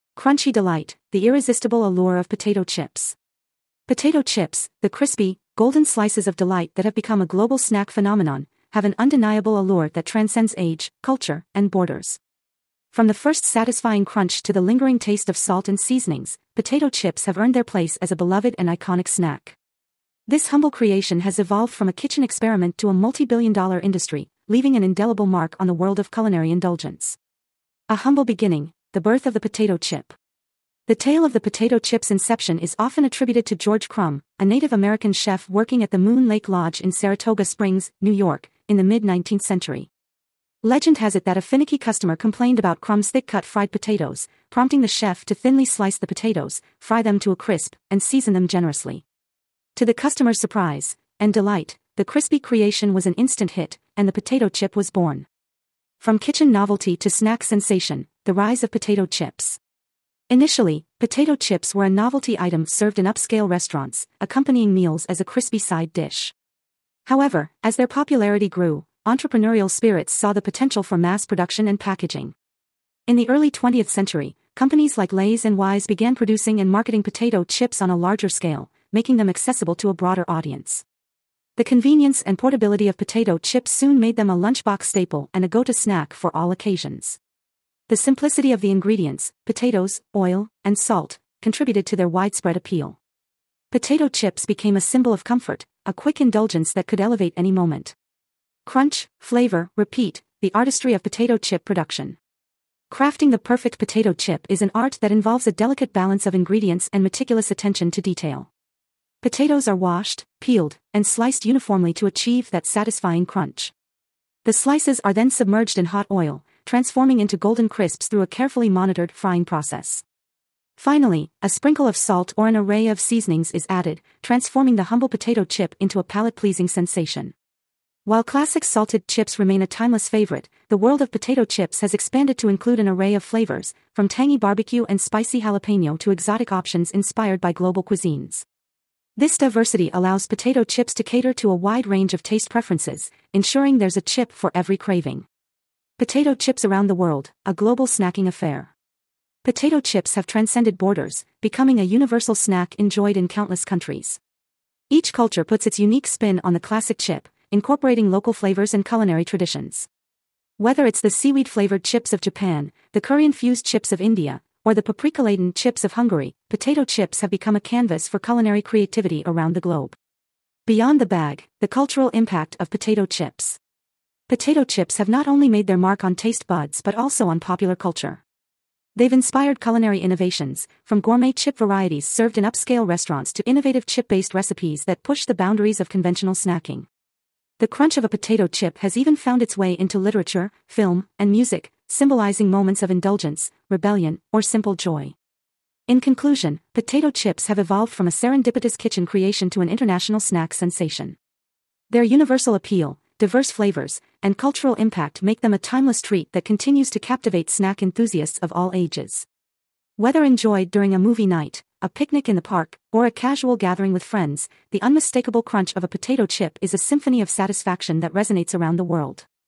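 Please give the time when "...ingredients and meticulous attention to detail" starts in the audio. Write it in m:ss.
1:46.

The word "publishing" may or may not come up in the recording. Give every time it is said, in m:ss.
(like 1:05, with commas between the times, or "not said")
not said.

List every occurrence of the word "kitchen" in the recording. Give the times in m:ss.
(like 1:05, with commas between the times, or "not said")
0:22, 0:56, 3:18.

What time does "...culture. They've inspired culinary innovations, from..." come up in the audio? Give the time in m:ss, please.
2:57.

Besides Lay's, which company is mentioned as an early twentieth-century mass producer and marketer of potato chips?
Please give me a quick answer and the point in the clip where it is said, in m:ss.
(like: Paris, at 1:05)
Wise, at 1:15.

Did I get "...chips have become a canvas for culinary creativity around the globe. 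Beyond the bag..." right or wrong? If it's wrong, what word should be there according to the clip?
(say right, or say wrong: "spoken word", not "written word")
right.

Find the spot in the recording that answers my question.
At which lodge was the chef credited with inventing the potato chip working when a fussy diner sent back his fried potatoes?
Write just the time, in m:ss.
0:35.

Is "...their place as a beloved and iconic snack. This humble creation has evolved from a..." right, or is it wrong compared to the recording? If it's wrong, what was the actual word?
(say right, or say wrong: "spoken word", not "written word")
right.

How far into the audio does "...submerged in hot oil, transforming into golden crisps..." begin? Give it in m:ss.
1:55.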